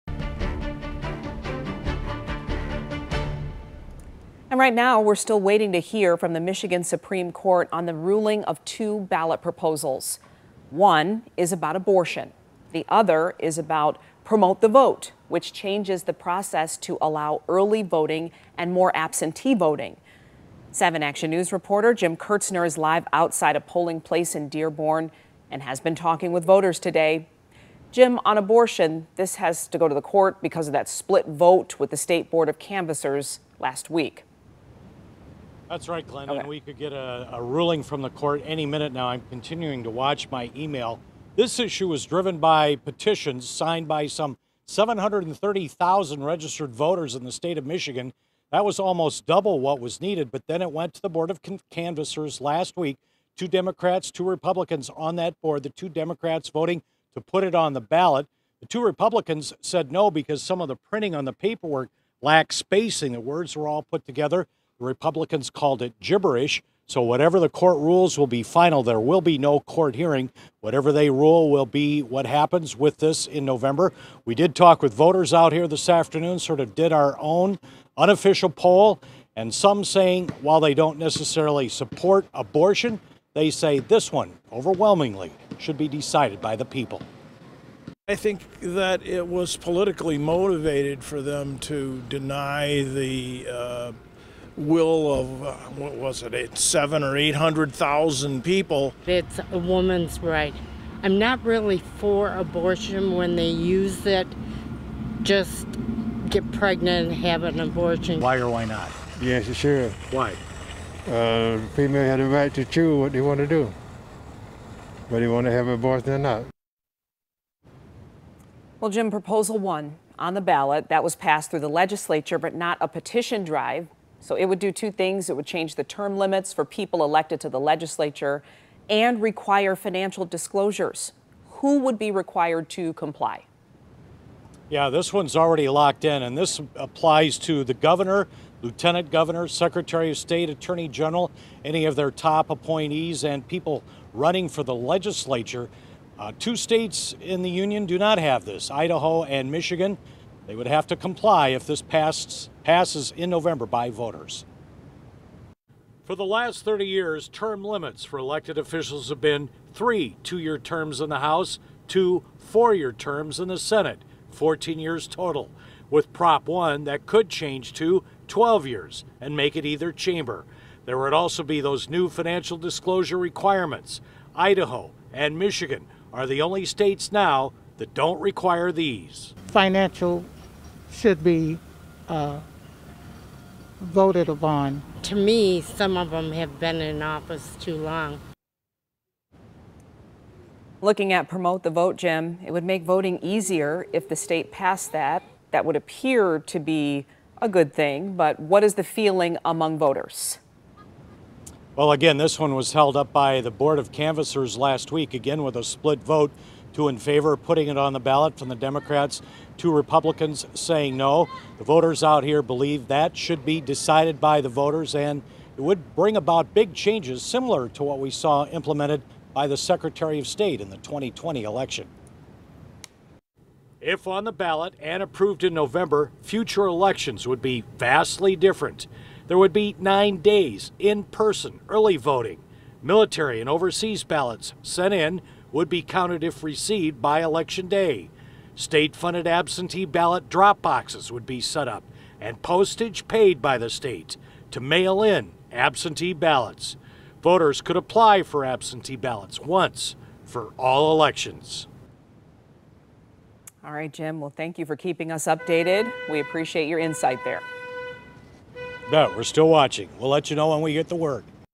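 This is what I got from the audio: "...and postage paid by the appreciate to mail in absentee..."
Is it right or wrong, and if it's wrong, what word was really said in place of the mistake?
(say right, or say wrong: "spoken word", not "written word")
wrong: "state", not "appreciate".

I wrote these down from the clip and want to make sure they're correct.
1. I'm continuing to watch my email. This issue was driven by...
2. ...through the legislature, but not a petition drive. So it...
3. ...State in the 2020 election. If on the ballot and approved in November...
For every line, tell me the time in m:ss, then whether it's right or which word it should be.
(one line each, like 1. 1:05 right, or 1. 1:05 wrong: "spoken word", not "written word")
1. 0:39 right
2. 2:01 right
3. 3:40 right.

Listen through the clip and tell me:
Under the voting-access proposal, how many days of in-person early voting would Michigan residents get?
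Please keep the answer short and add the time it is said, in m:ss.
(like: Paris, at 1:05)
9 days, at 3:49.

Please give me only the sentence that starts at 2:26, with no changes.
Uh, two states in the union do not have this Idaho and Michigan.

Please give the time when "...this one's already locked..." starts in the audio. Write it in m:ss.
2:14.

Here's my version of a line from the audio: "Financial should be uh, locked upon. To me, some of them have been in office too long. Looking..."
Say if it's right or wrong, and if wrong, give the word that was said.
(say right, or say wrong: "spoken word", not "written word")
wrong: "voted", not "locked".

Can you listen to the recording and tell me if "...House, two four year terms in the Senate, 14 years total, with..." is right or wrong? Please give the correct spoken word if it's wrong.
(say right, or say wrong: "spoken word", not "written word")
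right.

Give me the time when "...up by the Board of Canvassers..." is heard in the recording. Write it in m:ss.
3:22.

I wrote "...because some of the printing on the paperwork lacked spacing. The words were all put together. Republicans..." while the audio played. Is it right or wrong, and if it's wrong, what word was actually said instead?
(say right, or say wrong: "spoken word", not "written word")
right.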